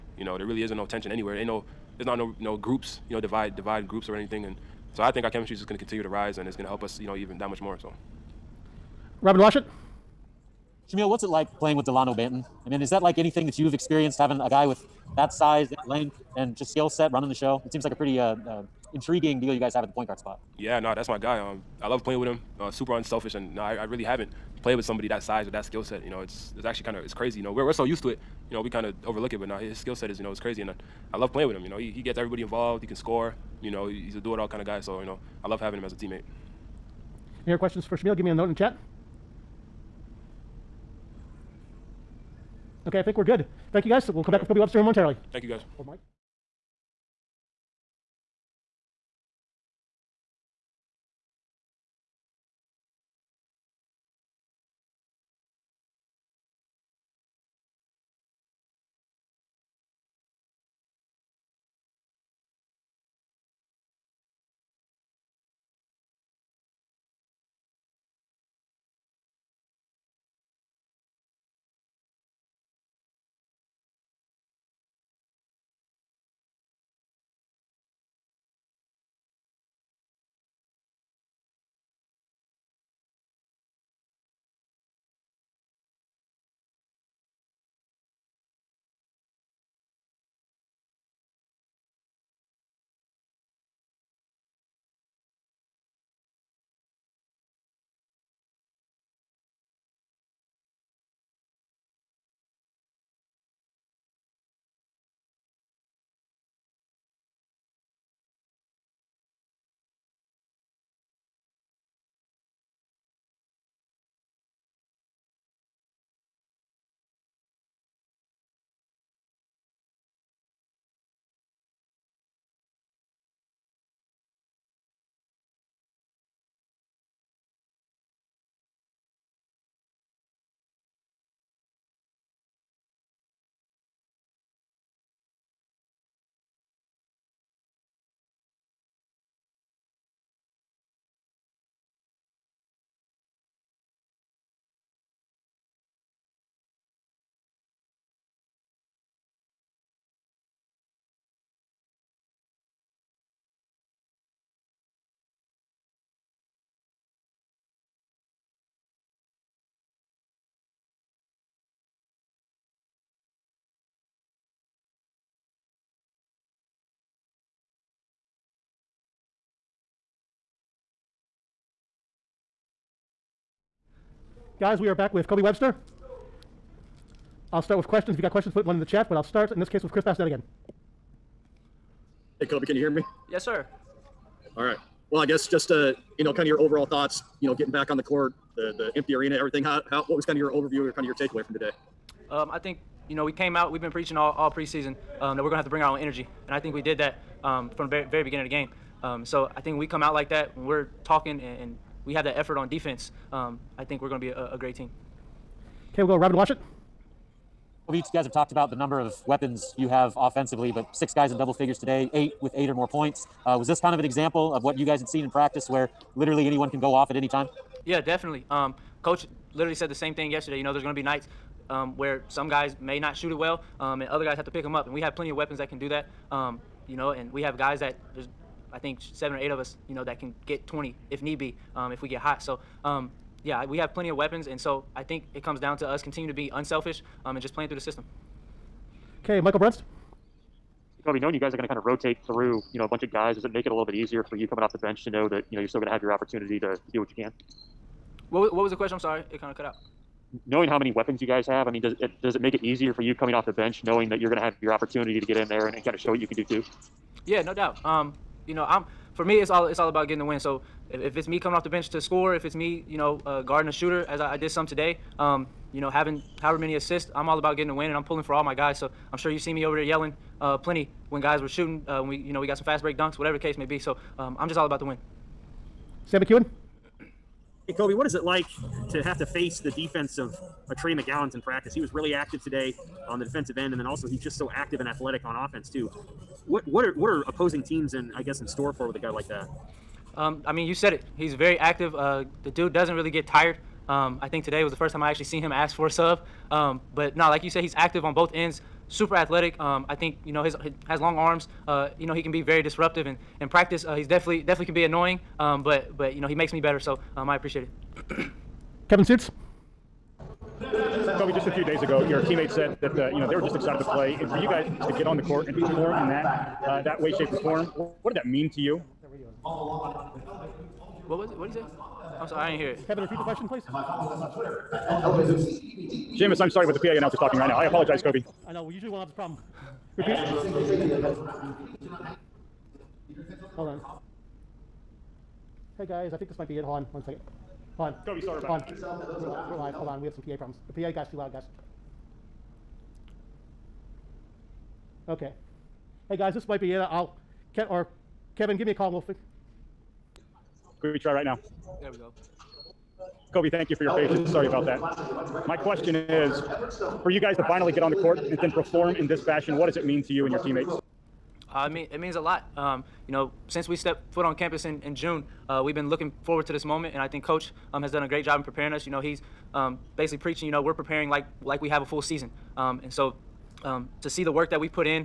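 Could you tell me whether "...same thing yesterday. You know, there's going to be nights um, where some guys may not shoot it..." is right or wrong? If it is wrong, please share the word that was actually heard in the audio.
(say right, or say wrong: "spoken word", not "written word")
right.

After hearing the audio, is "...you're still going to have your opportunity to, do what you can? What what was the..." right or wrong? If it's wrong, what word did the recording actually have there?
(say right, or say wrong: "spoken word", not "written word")
right.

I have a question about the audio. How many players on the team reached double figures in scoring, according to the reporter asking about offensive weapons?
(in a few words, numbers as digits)
6.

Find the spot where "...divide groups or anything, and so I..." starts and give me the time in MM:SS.
00:03.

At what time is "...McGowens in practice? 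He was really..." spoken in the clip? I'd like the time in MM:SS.
04:40.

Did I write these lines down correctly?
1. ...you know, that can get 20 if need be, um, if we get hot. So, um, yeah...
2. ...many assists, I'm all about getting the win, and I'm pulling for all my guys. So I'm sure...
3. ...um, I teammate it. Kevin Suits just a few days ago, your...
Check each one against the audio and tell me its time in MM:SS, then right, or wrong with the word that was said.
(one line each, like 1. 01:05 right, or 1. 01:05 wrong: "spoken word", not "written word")
1. 03:49 right
2. 04:26 right
3. 05:07 wrong: "appreciate", not "teammate".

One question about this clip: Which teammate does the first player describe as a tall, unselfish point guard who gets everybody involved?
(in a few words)
Delano Banton.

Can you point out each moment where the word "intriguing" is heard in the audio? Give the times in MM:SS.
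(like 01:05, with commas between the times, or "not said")
00:18.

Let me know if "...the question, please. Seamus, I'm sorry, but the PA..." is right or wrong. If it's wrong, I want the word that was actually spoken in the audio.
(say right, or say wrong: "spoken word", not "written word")
right.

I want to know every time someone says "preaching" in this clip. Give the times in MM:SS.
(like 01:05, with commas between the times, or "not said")
03:13, 06:10.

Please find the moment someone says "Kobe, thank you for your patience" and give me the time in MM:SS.
05:53.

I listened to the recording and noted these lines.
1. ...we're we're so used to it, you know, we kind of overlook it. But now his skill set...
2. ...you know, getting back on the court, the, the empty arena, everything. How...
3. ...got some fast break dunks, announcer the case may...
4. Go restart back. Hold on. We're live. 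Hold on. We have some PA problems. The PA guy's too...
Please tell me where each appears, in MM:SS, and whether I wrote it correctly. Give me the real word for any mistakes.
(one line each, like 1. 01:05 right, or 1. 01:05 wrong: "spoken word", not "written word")
1. 00:27 right
2. 03:07 right
3. 04:32 wrong: "whatever", not "announcer"
4. 05:38 right.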